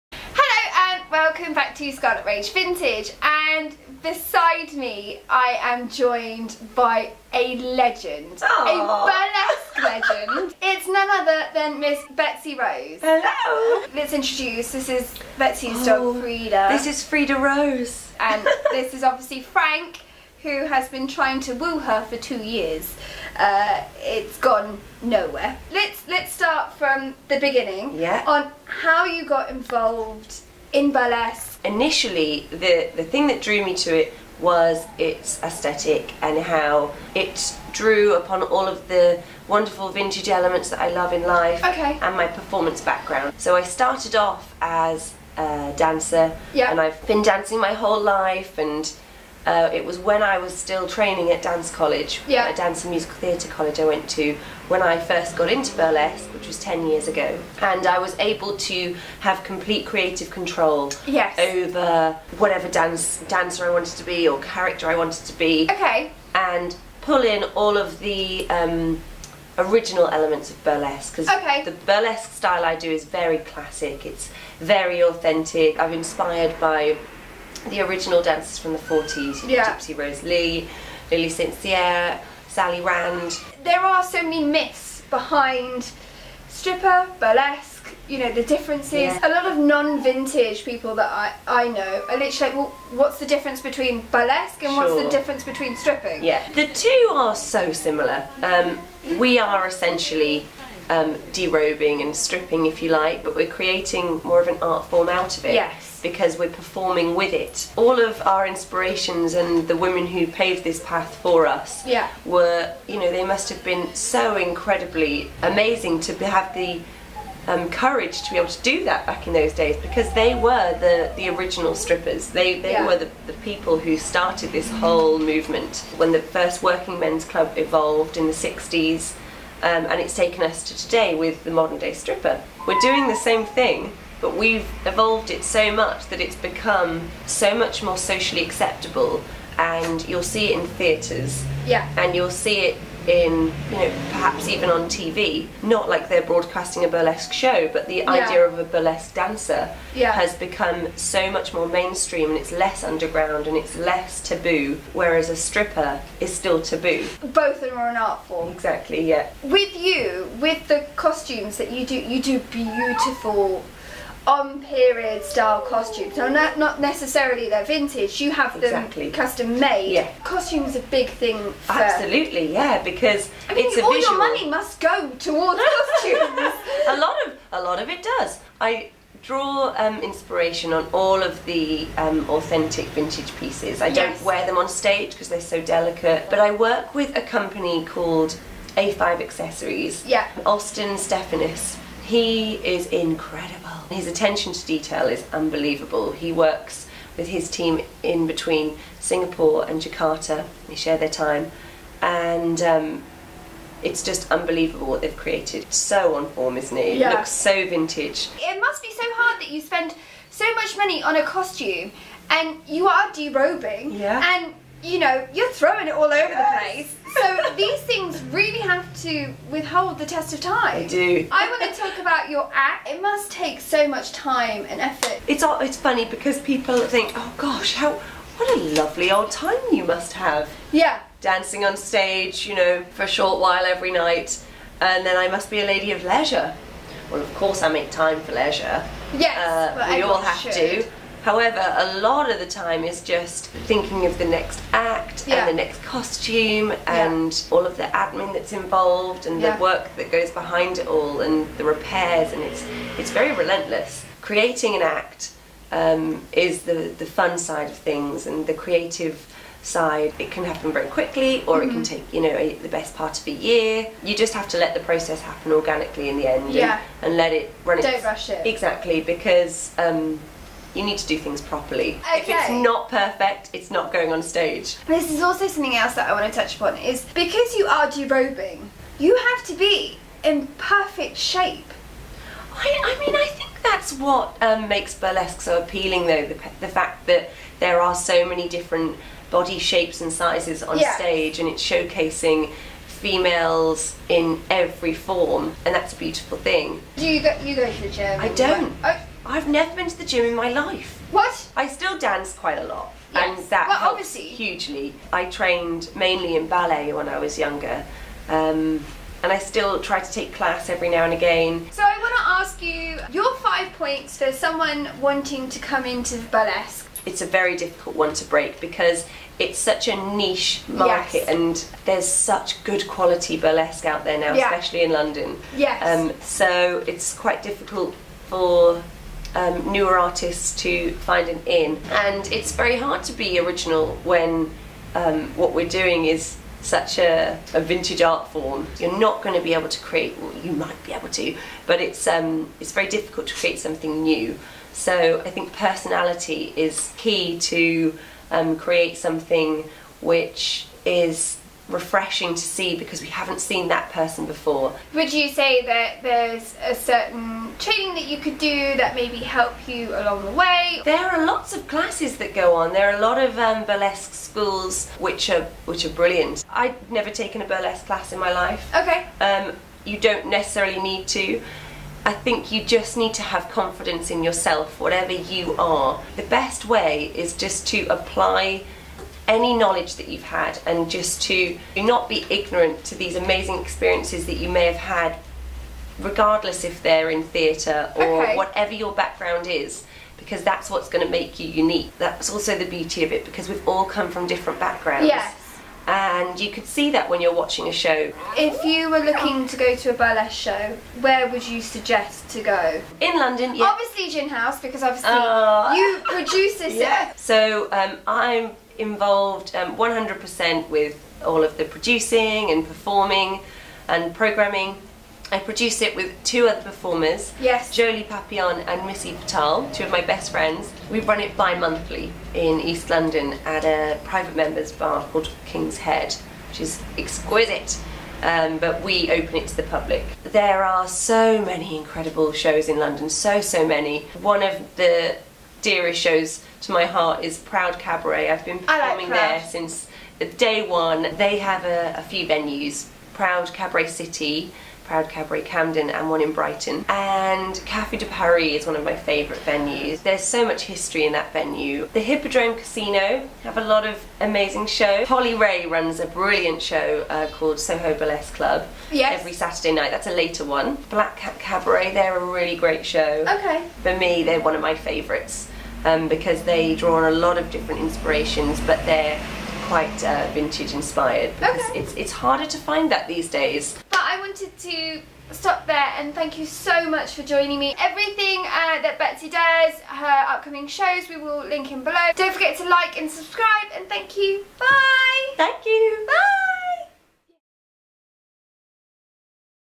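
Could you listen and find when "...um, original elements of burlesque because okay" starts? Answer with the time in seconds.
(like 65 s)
68 s.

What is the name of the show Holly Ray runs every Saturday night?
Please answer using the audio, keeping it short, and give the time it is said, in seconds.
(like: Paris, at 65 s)
Soho Burlesque Club, at 457 s.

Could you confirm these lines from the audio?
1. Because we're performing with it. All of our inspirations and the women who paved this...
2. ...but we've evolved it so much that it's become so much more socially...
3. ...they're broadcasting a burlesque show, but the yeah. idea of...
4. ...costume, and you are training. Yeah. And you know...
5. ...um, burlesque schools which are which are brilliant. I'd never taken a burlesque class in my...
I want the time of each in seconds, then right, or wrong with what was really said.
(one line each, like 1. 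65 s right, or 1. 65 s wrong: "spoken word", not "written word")
1. 106 s right
2. 134 s right
3. 146 s right
4. 211 s wrong: "derobing", not "training"
5. 363 s right.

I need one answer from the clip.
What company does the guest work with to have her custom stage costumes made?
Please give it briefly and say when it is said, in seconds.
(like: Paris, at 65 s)
A5 Accessories, at 188 s.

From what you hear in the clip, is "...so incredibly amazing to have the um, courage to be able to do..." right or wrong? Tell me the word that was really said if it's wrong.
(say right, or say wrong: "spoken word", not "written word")
right.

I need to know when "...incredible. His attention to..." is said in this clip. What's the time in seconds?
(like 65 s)
192 s.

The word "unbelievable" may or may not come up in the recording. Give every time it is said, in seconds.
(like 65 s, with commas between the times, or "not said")
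195 s, 204 s.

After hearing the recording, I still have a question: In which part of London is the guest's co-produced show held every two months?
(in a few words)
East London.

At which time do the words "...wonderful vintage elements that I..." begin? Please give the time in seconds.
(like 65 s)
39 s.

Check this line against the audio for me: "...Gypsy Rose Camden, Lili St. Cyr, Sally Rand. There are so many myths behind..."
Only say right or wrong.
wrong.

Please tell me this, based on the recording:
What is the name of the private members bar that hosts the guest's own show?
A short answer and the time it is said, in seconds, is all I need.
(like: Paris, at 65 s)
King's Head, at 425 s.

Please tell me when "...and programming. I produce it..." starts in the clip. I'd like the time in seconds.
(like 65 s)
413 s.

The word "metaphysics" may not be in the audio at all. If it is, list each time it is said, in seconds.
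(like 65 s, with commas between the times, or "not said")
not said.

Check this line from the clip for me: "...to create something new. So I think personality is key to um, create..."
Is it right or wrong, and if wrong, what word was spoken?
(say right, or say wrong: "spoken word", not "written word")
right.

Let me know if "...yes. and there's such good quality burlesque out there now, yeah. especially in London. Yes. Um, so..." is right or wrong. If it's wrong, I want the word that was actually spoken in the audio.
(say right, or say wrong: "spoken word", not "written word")
right.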